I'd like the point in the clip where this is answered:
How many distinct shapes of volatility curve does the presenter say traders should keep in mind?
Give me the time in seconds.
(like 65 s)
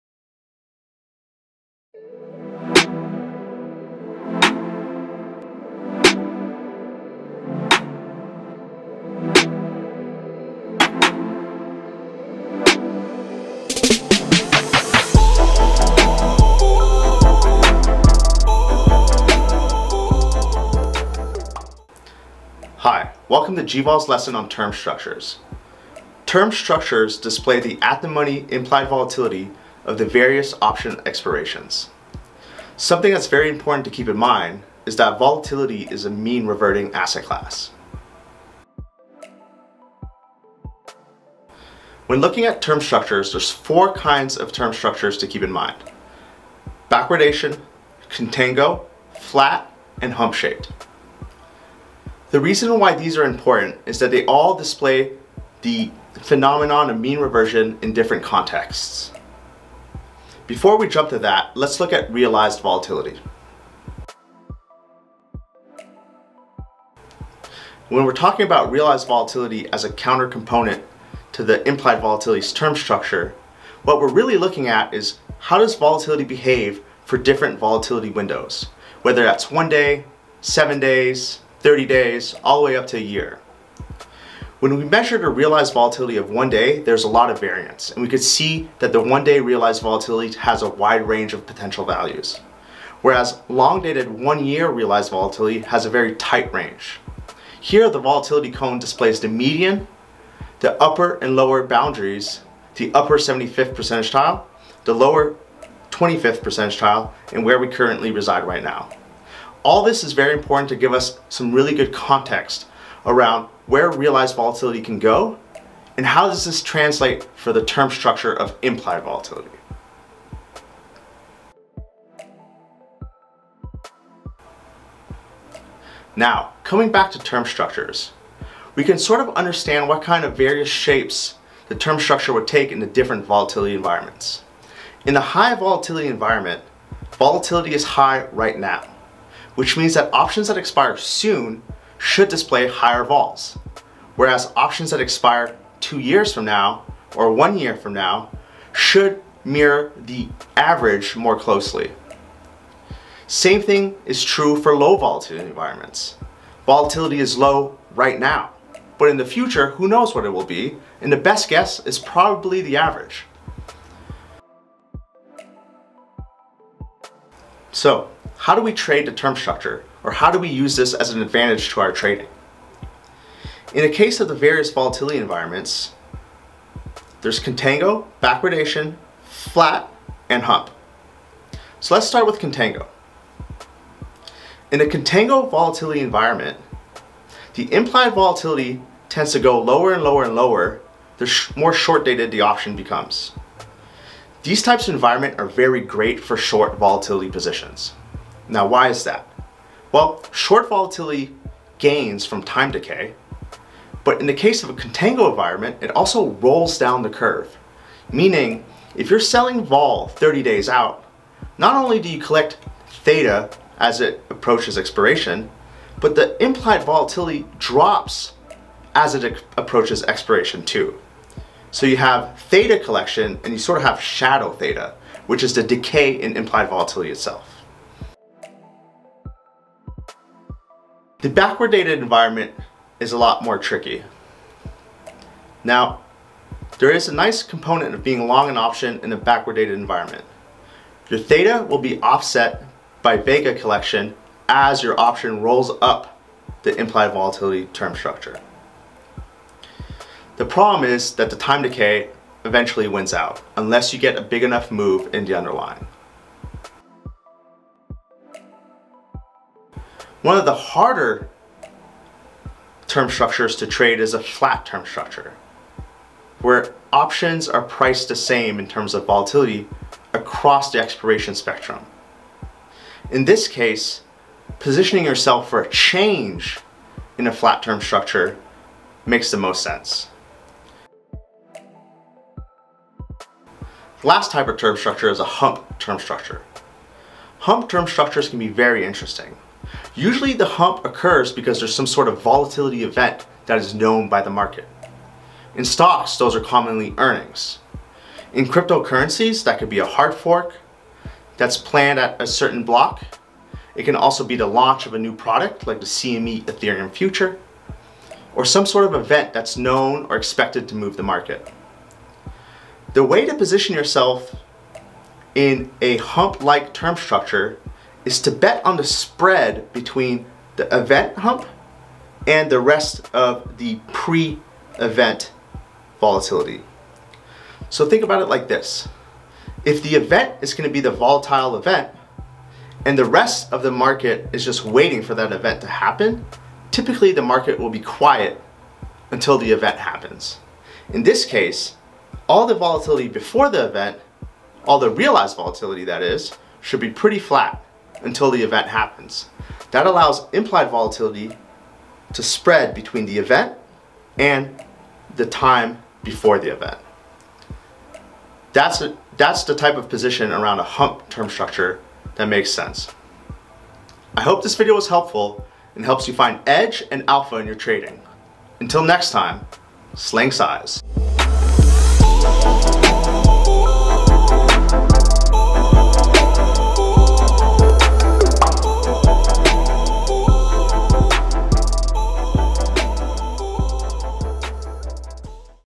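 43 s.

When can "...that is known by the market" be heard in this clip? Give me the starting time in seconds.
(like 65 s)
293 s.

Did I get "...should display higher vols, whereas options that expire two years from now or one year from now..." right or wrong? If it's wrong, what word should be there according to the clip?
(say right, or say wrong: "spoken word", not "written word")
right.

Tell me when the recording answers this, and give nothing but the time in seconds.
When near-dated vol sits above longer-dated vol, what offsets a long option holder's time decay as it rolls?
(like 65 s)
243 s.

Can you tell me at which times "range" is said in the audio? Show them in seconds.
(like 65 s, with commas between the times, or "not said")
91 s, 96 s.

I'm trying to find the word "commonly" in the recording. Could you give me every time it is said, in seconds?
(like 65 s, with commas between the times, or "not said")
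296 s.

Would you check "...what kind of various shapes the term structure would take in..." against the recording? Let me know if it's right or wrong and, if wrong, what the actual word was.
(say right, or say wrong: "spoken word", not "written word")
right.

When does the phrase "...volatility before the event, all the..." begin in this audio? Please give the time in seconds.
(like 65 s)
342 s.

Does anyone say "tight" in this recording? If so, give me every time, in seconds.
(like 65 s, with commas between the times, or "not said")
96 s.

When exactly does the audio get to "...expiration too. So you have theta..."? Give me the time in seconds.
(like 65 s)
220 s.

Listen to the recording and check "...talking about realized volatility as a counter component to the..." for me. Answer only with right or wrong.
right.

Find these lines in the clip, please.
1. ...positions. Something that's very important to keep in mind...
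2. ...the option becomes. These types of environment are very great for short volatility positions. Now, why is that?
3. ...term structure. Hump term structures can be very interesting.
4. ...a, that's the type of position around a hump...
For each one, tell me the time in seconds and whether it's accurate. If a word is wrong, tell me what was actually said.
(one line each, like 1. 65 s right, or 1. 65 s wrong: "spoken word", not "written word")
1. 31 s wrong: "expirations", not "positions"
2. 192 s right
3. 285 s right
4. 358 s right.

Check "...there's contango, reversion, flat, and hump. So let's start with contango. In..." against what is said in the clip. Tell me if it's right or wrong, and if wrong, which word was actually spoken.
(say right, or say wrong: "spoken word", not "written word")
wrong: "backwardation", not "reversion".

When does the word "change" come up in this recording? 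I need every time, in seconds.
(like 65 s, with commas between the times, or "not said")
275 s.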